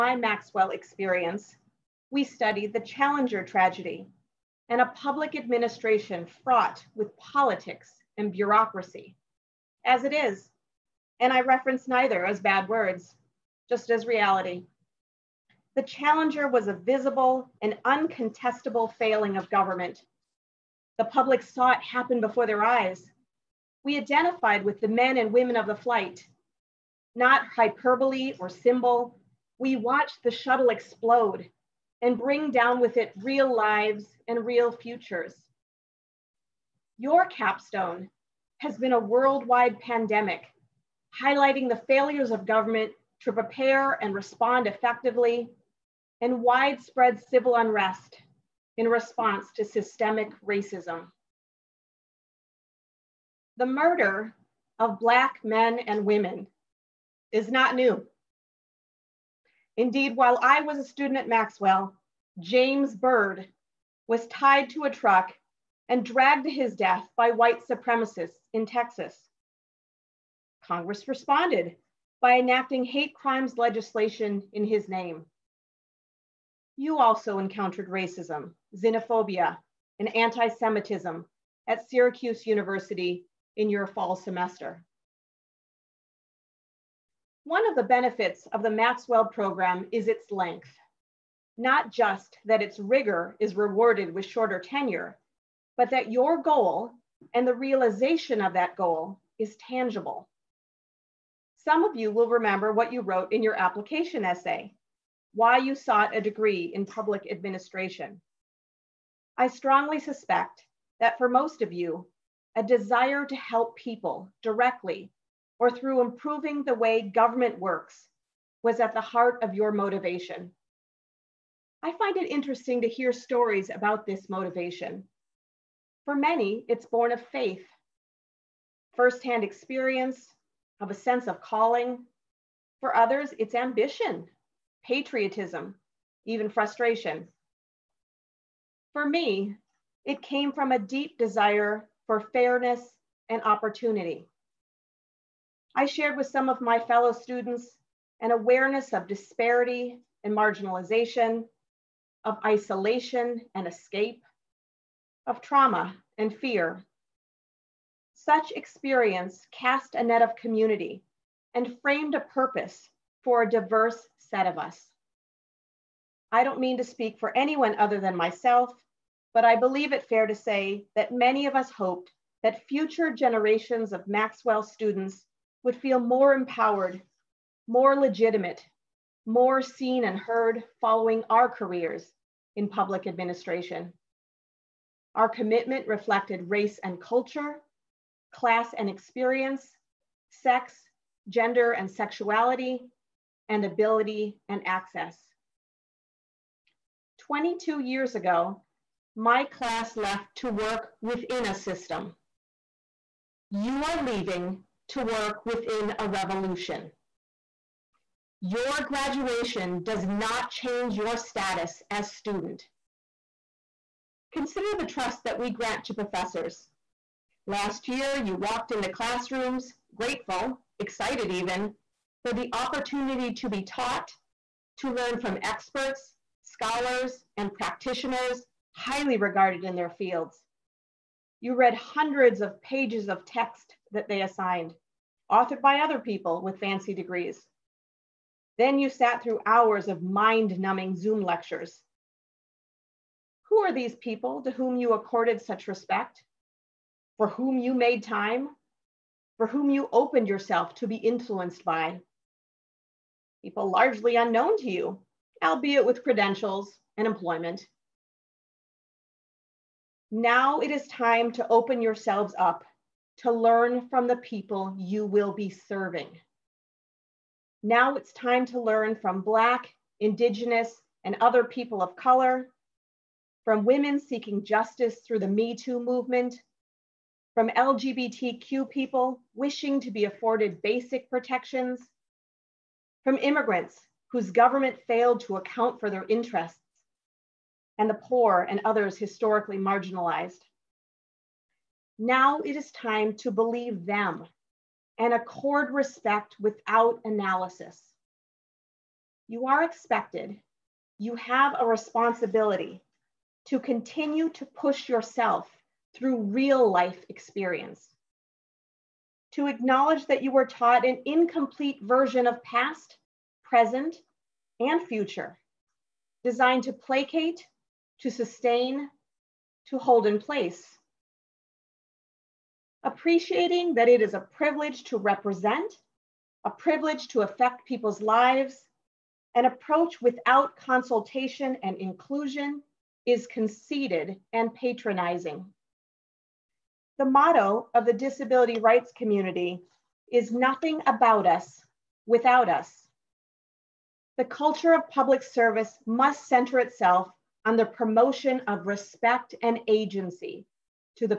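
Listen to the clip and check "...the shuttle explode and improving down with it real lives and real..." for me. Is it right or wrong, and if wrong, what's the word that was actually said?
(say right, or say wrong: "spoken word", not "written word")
wrong: "bring", not "improving".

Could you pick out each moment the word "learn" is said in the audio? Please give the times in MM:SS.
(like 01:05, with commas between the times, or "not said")
03:44, 04:23, 04:28.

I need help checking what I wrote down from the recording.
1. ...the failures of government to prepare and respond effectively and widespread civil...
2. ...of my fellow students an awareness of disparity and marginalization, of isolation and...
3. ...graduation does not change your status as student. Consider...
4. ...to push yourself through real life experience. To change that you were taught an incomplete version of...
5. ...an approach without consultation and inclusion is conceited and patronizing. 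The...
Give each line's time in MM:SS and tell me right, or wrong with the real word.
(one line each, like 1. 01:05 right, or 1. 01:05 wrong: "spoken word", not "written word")
1. 00:41 right
2. 02:26 right
3. 03:28 right
4. 05:04 wrong: "acknowledge", not "change"
5. 05:29 right.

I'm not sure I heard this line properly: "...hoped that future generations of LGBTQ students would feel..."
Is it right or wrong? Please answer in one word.
wrong.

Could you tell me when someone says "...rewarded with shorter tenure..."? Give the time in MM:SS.
01:33.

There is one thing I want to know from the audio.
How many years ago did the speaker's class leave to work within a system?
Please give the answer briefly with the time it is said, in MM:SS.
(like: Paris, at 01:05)
22, at 03:17.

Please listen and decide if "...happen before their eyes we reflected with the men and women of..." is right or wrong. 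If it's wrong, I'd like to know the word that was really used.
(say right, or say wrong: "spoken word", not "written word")
wrong: "identified", not "reflected".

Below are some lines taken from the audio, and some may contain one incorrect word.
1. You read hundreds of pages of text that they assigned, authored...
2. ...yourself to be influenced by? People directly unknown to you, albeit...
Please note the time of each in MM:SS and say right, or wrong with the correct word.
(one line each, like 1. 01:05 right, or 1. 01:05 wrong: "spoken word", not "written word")
1. 03:51 right
2. 04:10 wrong: "largely", not "directly".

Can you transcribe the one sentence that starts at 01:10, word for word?
Congress responded by enacting hate crimes legislation in his name.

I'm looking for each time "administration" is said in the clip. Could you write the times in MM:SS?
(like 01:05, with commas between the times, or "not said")
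00:05, 01:47, 03:03.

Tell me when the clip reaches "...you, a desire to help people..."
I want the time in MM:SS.
01:51.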